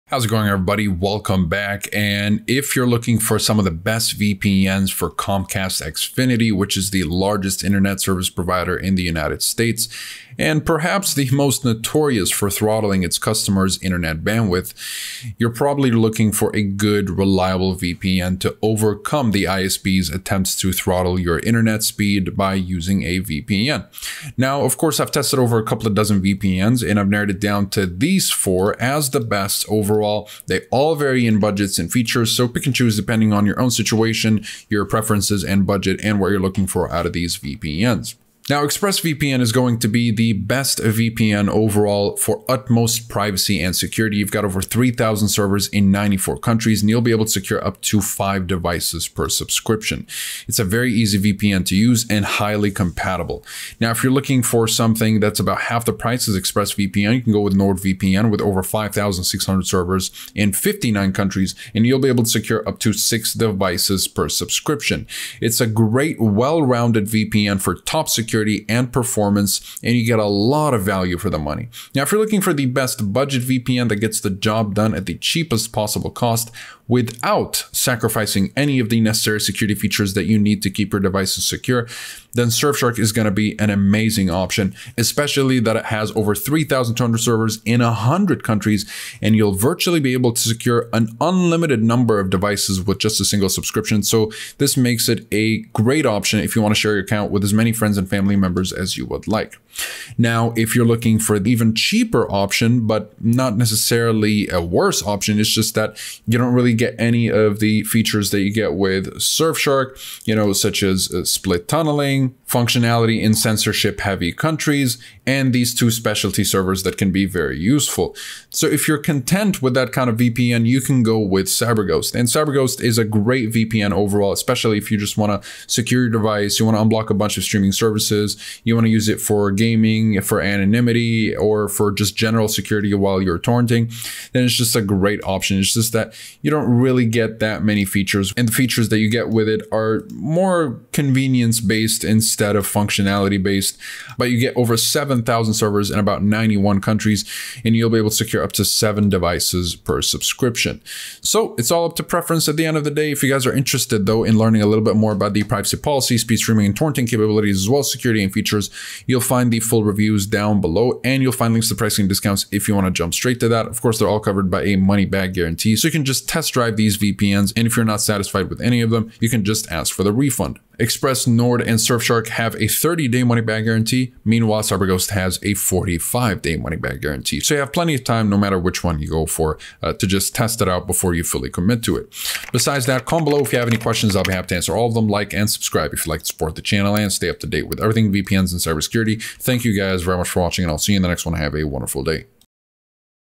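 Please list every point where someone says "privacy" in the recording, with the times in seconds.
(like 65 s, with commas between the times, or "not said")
43 s, 155 s.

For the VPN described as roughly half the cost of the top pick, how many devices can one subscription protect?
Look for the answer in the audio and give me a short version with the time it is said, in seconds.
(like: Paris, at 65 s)
6, at 62 s.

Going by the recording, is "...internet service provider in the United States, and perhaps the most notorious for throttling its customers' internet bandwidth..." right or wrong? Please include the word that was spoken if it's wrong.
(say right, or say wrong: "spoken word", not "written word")
right.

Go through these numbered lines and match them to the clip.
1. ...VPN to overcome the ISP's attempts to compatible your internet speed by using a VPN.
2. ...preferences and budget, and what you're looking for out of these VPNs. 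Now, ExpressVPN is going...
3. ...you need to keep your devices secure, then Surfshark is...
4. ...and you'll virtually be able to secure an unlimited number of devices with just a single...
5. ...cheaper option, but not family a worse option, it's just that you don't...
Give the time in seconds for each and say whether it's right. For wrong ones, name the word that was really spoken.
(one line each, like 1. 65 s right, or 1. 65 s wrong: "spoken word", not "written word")
1. 17 s wrong: "throttle", not "compatible"
2. 34 s right
3. 80 s right
4. 89 s right
5. 101 s wrong: "necessarily", not "family".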